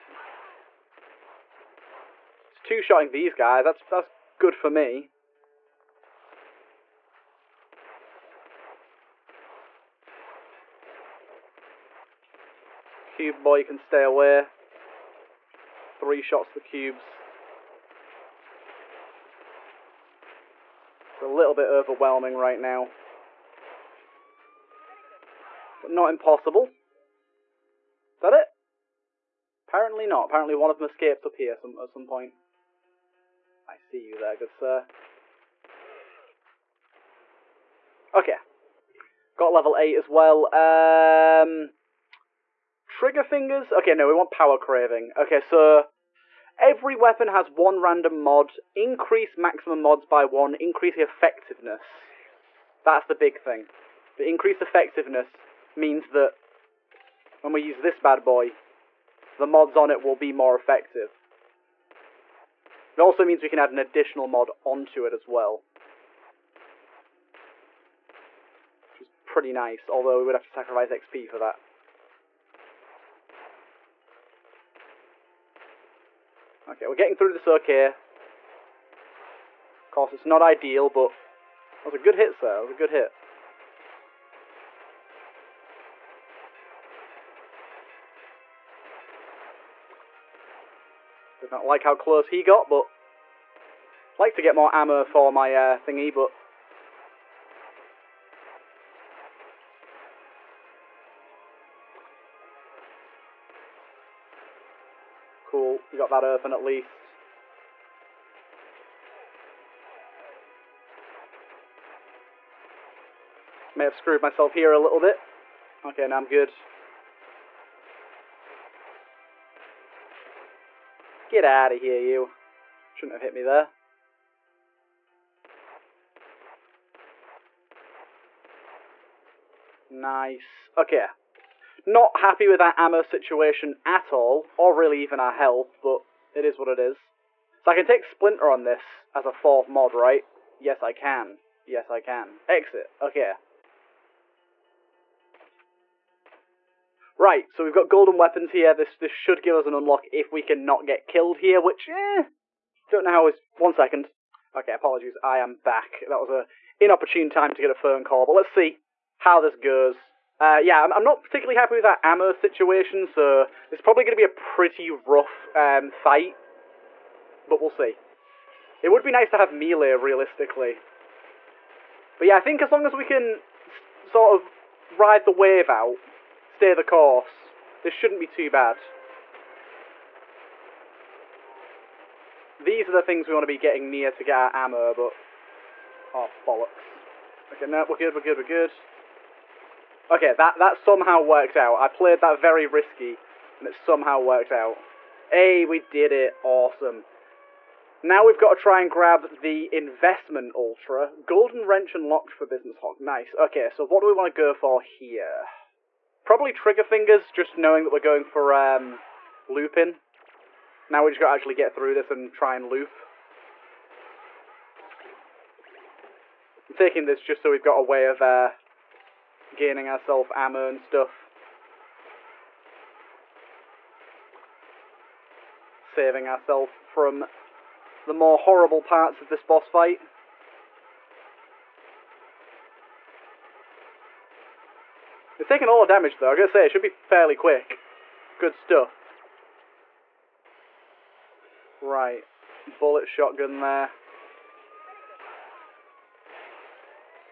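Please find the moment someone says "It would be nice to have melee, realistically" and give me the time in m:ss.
2:48.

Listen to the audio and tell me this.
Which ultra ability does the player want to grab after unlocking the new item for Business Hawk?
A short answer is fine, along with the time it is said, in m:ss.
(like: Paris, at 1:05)
Investment ultra, at 3:19.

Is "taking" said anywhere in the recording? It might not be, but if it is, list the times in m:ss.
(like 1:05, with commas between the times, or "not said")
3:36, 3:55.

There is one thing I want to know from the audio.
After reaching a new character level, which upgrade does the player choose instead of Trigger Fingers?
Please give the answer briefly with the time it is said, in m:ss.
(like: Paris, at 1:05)
Power craving, at 0:44.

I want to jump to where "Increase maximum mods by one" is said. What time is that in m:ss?
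0:48.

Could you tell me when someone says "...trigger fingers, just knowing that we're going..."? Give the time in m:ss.
3:26.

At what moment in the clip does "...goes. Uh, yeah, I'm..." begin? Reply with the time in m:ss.
2:39.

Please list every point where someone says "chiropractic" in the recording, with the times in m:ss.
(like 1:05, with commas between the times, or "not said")
not said.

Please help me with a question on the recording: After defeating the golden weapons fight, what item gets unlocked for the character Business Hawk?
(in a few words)
Golden wrench.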